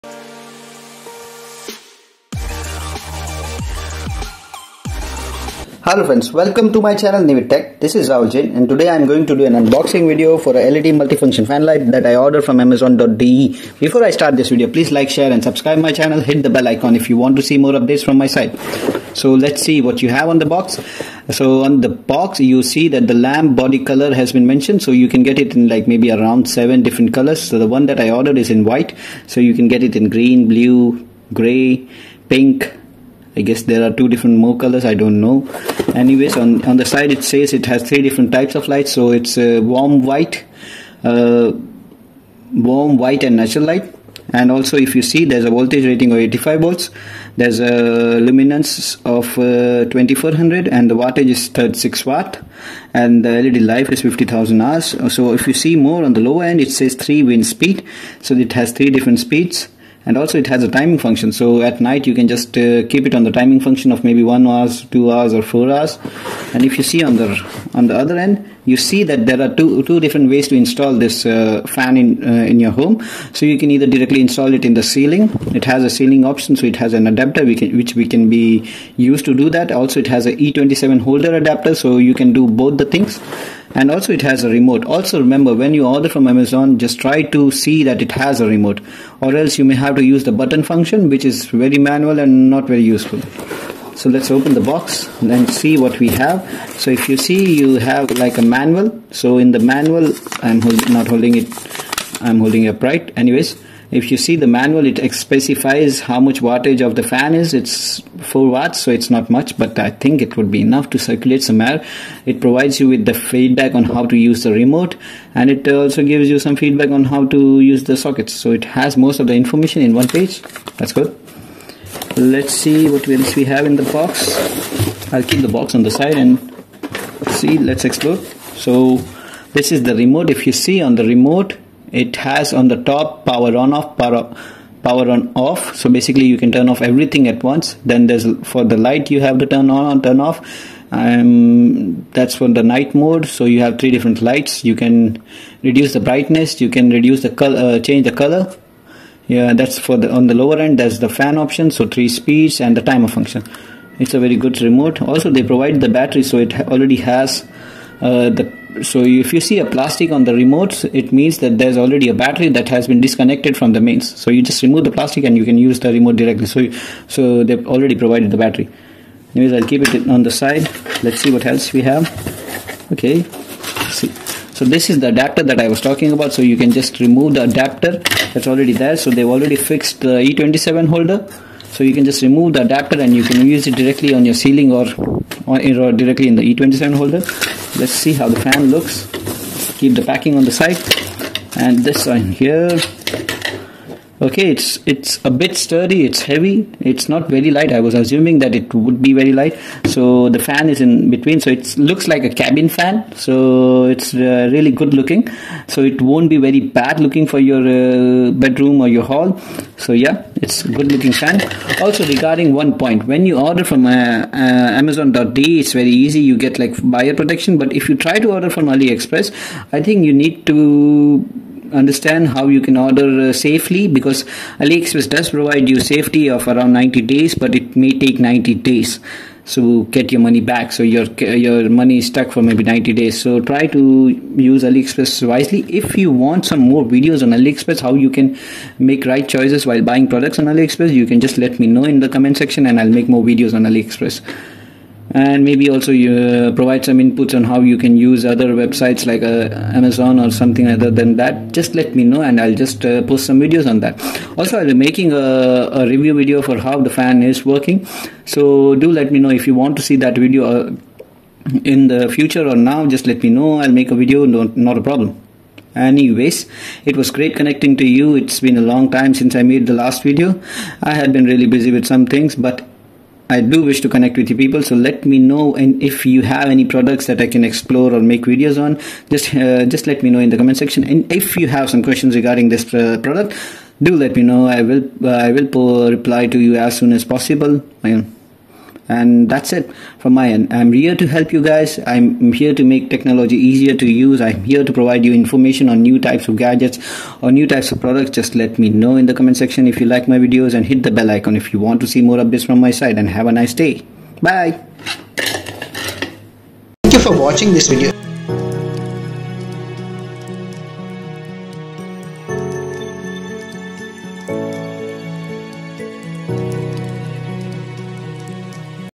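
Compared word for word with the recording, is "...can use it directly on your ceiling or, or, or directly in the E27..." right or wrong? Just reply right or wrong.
right.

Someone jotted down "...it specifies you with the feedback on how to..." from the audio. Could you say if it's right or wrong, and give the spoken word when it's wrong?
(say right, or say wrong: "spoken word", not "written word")
wrong: "provides", not "specifies".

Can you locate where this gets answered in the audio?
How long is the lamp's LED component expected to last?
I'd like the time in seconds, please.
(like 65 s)
54 s.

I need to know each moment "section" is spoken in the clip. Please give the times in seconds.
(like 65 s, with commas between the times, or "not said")
242 s, 280 s, 299 s.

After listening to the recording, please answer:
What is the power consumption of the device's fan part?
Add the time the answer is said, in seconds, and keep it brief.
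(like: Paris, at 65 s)
4 watts, at 108 s.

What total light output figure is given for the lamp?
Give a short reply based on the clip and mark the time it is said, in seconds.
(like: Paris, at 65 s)
2400, at 49 s.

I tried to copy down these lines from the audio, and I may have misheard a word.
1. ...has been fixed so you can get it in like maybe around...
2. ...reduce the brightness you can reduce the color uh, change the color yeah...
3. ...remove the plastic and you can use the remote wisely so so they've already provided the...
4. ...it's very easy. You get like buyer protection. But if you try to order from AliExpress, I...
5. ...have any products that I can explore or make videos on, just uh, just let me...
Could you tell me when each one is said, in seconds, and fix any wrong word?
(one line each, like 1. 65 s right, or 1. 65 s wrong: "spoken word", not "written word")
1. 24 s wrong: "mentioned", not "fixed"
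2. 145 s right
3. 164 s wrong: "directly", not "wisely"
4. 215 s right
5. 276 s right.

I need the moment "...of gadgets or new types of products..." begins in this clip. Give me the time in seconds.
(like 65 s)
296 s.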